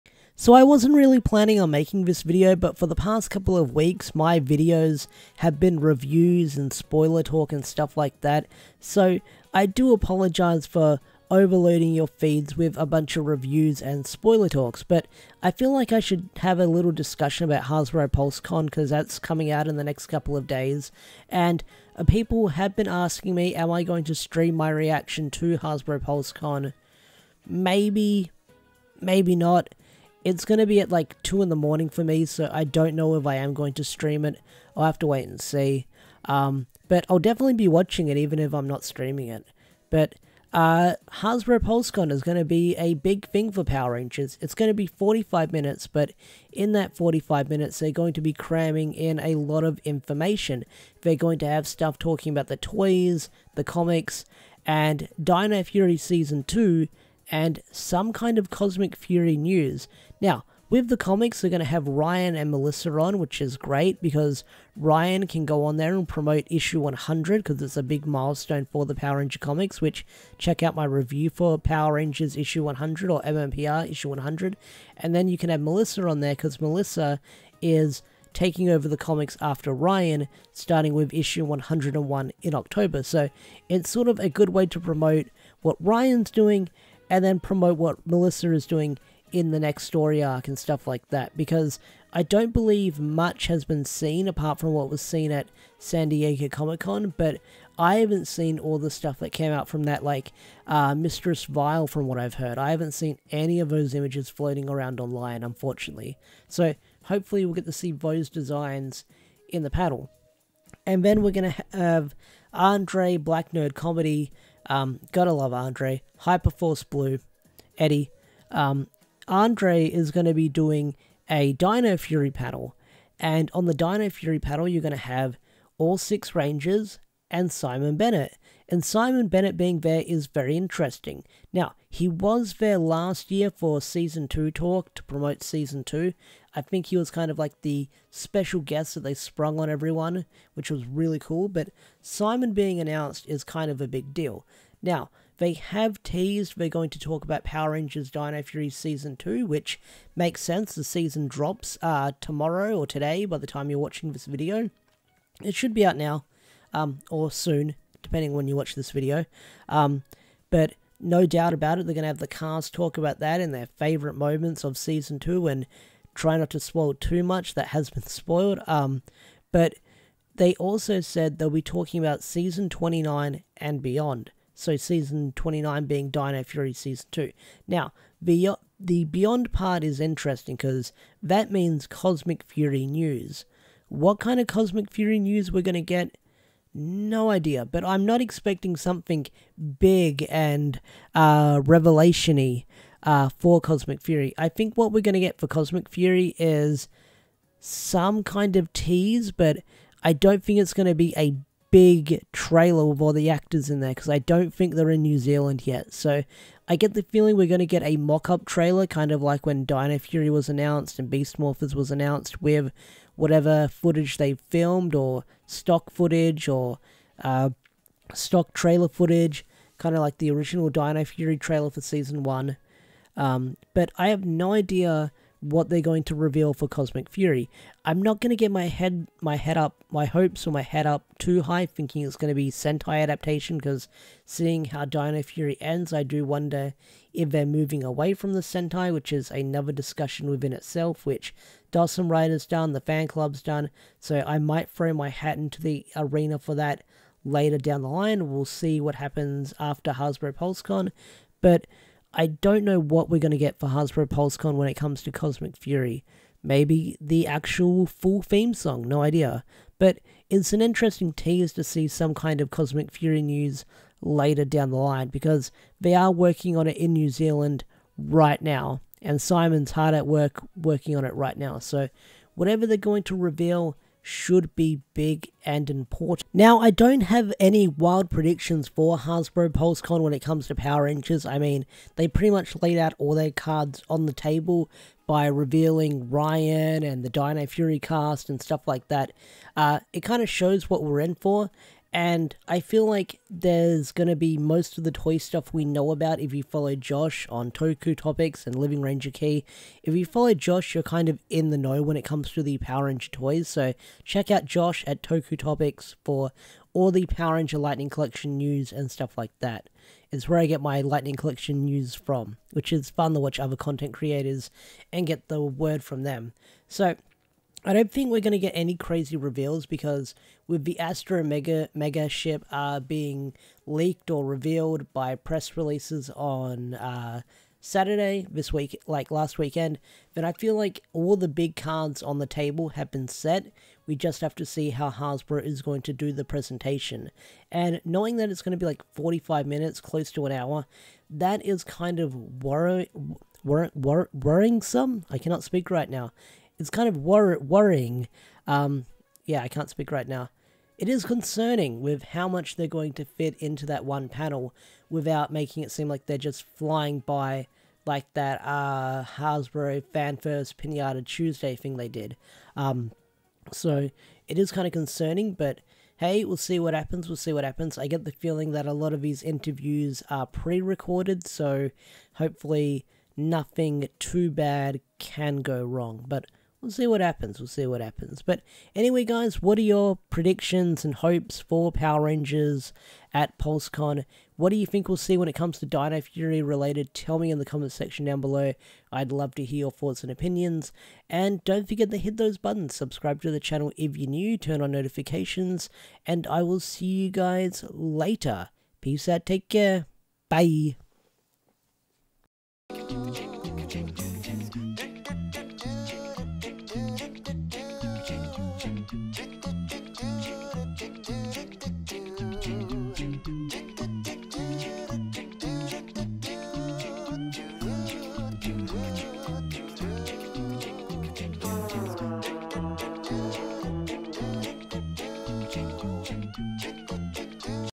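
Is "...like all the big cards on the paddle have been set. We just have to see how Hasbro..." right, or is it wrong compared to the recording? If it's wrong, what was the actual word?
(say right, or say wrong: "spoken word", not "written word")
wrong: "table", not "paddle".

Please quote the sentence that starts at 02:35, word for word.
It should be out now, um, or soon, depending when you watch this video.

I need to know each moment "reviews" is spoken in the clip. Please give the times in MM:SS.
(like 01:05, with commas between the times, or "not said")
00:05, 00:13, 01:10.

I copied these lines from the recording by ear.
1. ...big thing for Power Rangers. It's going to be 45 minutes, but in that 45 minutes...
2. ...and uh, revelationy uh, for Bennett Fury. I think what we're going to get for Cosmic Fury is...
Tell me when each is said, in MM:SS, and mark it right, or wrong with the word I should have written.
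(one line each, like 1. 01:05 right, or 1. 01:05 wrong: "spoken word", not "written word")
1. 00:42 right
2. 03:10 wrong: "Cosmic", not "Bennett".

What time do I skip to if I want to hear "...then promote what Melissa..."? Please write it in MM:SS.
01:27.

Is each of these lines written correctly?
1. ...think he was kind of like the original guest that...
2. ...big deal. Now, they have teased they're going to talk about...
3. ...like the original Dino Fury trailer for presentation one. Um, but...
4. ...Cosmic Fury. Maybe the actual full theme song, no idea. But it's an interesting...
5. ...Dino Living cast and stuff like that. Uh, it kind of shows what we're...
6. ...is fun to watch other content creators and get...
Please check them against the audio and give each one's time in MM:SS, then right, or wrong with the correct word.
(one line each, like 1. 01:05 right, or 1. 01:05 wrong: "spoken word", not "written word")
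1. 02:16 wrong: "special", not "original"
2. 02:23 right
3. 03:40 wrong: "season", not "presentation"
4. 04:15 right
5. 04:47 wrong: "Fury", not "Living"
6. 05:12 right.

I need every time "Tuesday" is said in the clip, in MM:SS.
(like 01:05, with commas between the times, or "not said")
06:01.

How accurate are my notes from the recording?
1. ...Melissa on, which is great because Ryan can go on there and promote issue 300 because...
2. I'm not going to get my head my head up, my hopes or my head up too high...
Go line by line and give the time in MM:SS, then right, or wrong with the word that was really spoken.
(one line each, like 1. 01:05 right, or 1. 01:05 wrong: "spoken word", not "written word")
1. 01:02 wrong: "100", not "300"
2. 03:47 right.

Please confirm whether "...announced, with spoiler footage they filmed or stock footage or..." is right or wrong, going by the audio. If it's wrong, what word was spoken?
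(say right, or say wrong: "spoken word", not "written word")
wrong: "whatever", not "spoiler".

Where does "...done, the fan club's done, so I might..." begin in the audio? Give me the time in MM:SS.
04:02.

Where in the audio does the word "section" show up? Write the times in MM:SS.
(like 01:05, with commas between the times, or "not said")
06:27.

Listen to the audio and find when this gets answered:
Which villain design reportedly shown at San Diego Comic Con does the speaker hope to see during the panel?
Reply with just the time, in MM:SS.
01:40.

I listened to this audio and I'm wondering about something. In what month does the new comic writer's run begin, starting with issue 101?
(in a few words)
October.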